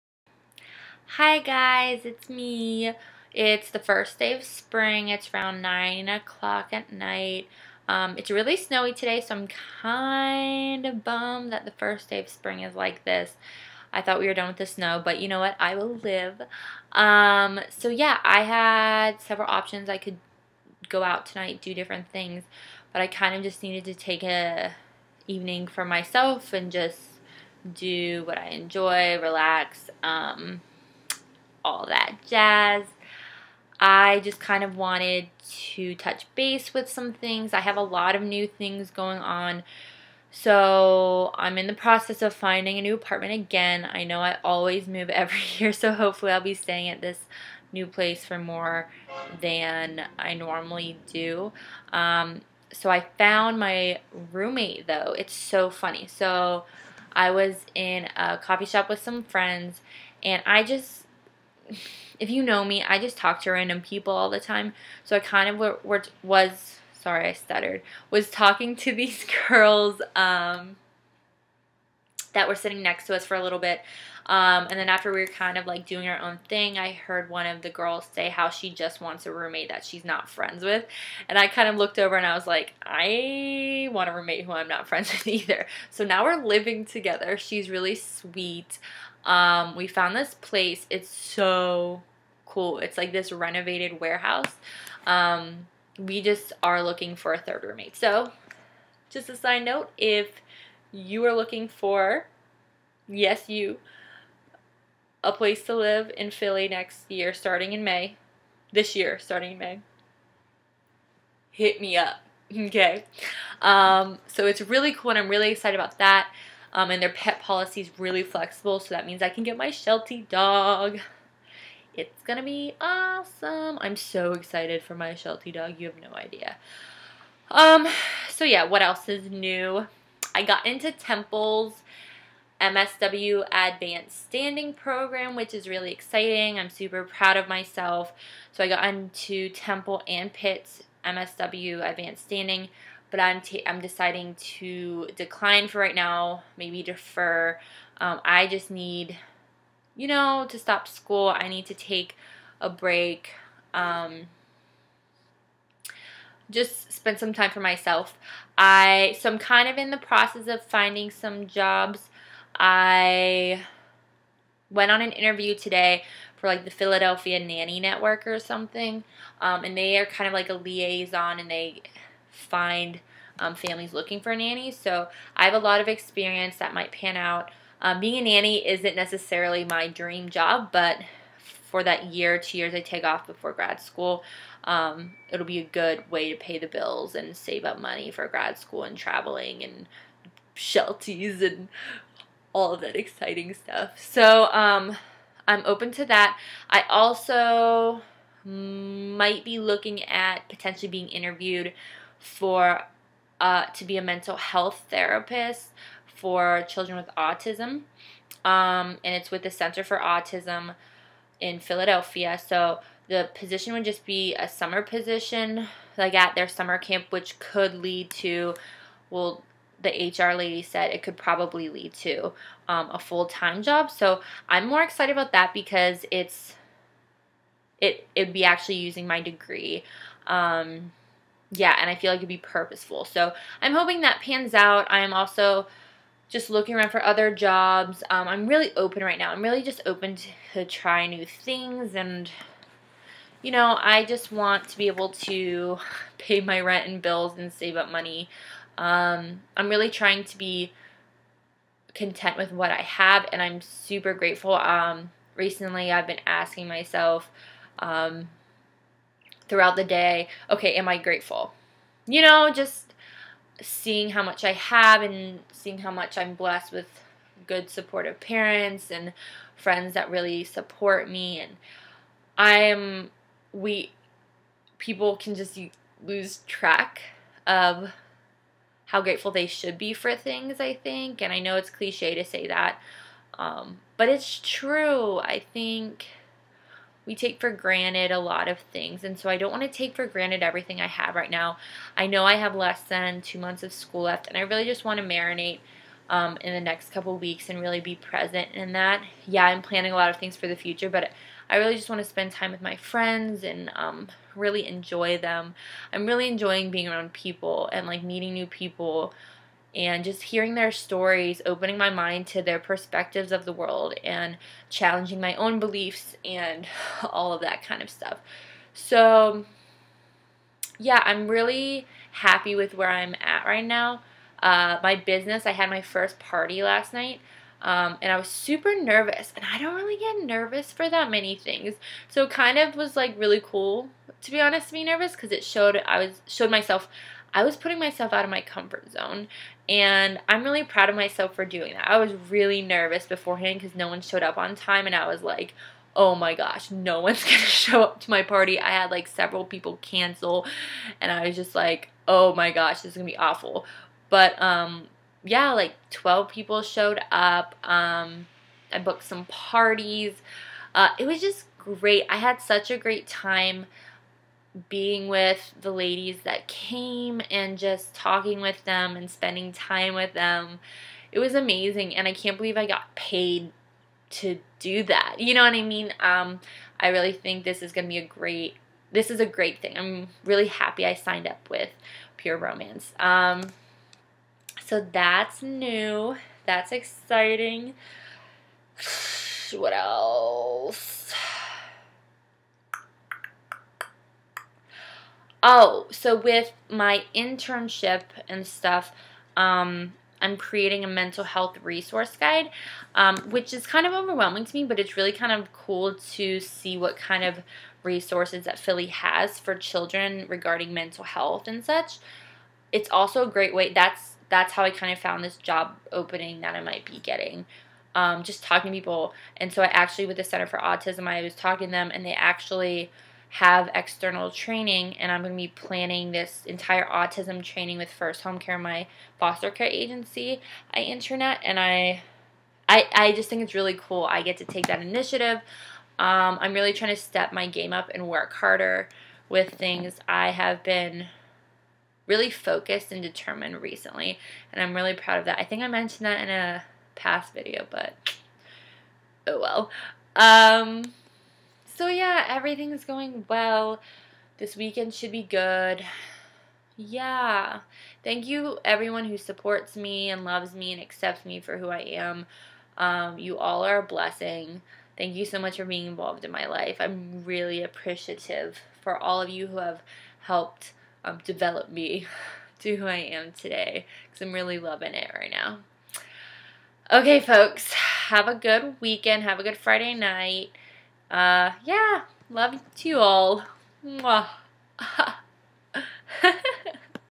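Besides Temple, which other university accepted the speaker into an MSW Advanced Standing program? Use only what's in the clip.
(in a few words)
Pitt.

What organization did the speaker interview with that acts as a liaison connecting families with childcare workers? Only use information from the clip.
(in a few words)
Philadelphia Nanny Network.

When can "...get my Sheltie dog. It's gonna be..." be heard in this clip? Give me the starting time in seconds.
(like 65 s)
119 s.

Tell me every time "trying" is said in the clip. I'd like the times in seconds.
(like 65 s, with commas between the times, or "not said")
249 s, 436 s.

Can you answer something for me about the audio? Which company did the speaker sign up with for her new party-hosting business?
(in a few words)
Pure Romance.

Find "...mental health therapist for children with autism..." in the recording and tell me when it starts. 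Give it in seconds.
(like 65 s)
204 s.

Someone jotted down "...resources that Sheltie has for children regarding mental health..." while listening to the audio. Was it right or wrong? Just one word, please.
wrong.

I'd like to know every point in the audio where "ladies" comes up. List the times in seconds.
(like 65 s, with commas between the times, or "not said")
365 s.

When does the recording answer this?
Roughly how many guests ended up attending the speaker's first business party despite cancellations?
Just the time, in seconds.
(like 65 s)
355 s.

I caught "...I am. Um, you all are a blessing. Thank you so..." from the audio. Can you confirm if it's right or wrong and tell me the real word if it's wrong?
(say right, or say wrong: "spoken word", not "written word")
right.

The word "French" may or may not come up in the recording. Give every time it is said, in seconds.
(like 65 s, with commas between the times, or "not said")
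not said.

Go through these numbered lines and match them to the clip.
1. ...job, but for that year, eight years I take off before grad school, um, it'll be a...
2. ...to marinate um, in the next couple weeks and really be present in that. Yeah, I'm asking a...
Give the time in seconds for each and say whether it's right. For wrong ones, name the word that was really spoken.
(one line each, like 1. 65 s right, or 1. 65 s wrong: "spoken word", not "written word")
1. 180 s wrong: "two", not "eight"
2. 294 s wrong: "planning", not "asking".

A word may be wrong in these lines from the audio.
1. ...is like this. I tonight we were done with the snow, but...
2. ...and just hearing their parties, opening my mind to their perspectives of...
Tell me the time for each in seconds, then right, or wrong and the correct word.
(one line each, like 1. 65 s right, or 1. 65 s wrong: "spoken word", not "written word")
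1. 12 s wrong: "thought", not "tonight"
2. 309 s wrong: "stories", not "parties".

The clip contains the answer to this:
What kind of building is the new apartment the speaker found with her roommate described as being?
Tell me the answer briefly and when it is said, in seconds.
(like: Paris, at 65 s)
renovated warehouse, at 93 s.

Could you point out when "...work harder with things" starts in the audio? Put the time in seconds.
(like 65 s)
438 s.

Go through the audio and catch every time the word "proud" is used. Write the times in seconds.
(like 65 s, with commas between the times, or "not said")
137 s, 340 s, 444 s.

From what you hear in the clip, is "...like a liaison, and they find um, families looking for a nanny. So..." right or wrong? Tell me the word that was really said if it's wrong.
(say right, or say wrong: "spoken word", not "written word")
right.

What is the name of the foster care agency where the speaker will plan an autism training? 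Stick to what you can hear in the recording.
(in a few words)
First Home Care.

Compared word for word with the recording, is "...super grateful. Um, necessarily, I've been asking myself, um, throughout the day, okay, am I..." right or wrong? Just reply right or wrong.
wrong.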